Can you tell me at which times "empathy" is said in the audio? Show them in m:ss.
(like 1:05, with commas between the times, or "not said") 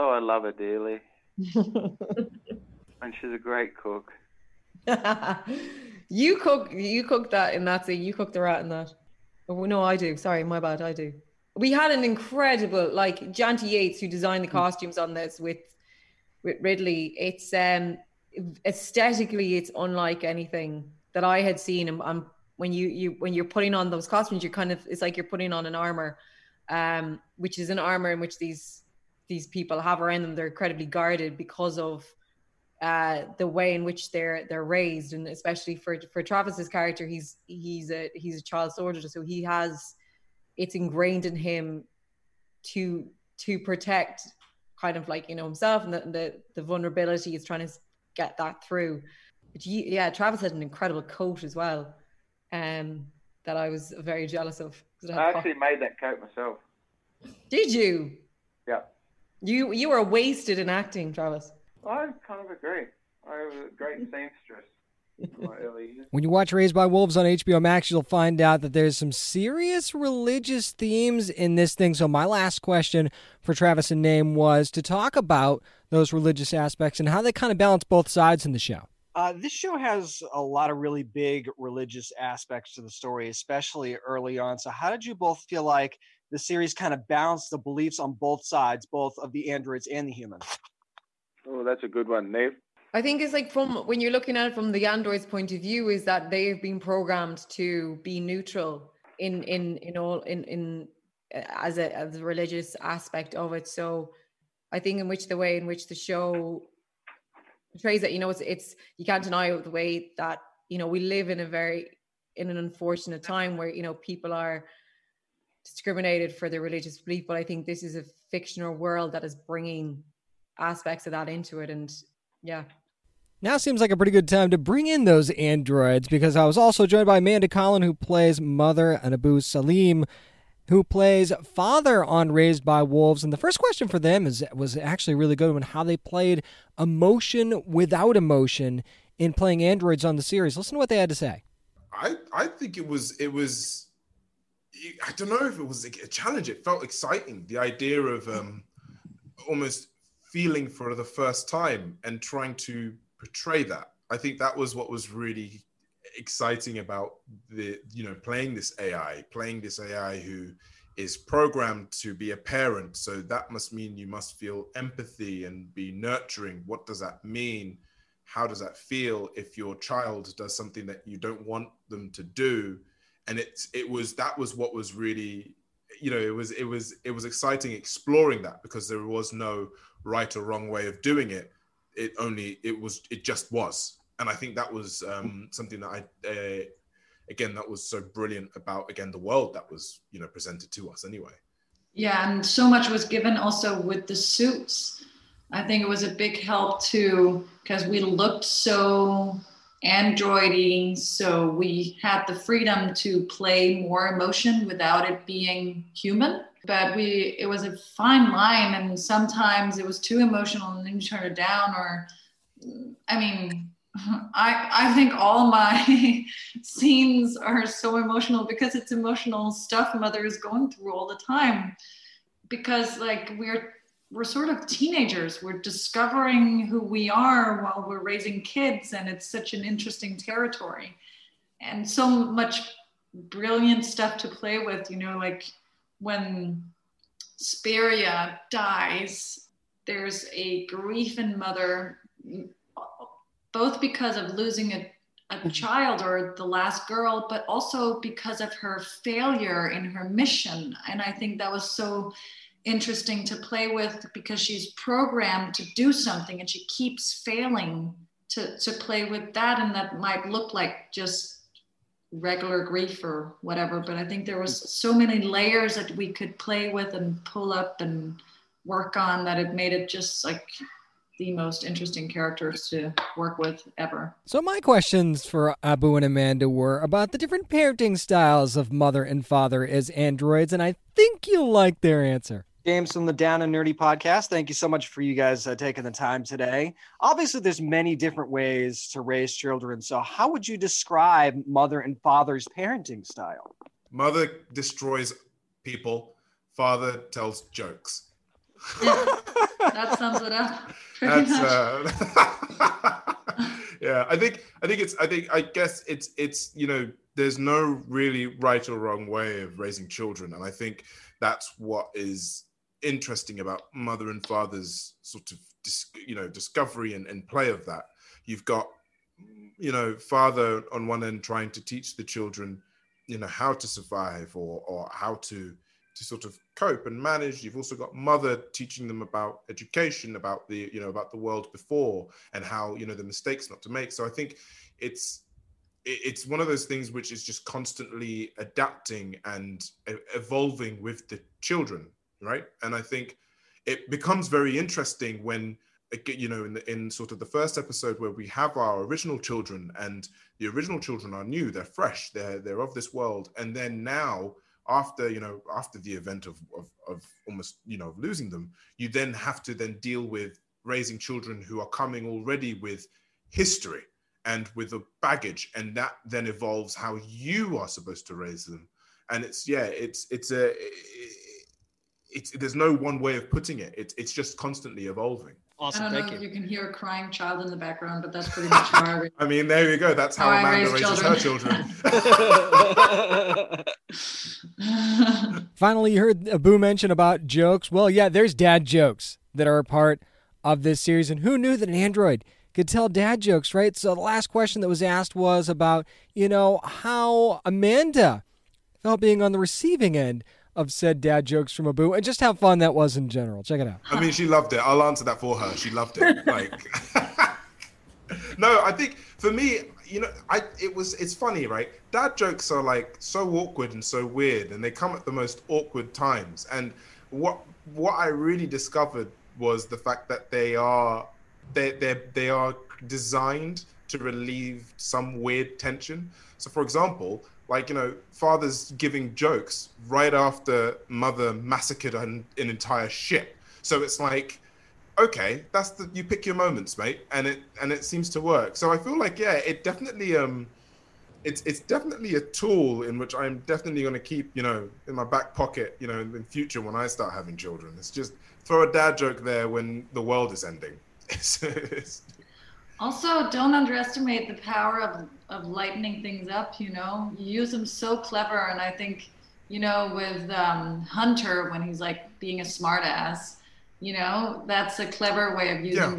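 2:44.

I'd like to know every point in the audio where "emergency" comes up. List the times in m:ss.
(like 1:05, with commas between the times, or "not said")
not said.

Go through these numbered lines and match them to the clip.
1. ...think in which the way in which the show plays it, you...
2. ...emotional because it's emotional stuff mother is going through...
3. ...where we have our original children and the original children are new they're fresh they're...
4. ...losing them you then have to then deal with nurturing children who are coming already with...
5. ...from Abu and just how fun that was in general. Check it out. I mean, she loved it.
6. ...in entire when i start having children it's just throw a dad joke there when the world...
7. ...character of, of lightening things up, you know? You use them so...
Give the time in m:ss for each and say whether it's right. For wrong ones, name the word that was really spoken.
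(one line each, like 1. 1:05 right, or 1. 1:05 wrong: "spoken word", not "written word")
1. 1:44 wrong: "portrays", not "plays"
2. 3:37 right
3. 5:47 right
4. 5:57 wrong: "raising", not "nurturing"
5. 6:41 right
6. 7:26 wrong: "future", not "entire"
7. 7:34 wrong: "power", not "character".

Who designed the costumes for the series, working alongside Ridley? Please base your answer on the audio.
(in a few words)
Janty Yates.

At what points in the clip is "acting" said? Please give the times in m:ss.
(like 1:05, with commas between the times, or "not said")
1:00.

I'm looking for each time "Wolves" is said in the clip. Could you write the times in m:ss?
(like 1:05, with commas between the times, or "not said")
1:06, 2:12.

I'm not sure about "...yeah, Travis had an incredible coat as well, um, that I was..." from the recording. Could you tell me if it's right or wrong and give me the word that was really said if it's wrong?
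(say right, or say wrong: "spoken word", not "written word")
right.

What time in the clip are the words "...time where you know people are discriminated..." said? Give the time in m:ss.
1:53.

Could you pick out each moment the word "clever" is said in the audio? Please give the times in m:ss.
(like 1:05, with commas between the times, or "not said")
7:37, 7:44.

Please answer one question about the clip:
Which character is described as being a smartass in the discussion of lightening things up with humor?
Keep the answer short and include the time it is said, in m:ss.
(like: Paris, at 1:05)
Hunter, at 7:40.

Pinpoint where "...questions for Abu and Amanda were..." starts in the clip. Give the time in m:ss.
4:34.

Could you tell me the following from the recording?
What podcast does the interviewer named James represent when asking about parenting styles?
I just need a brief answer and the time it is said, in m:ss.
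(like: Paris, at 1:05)
Down and Nerdy, at 4:43.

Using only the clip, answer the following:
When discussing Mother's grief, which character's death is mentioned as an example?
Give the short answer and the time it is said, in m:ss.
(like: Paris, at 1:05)
Speria, at 3:57.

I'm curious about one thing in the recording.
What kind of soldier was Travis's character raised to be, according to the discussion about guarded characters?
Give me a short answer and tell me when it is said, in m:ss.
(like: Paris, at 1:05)
Child soldier, at 0:38.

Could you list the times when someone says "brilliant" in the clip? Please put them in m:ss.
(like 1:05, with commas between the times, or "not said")
3:08, 3:53.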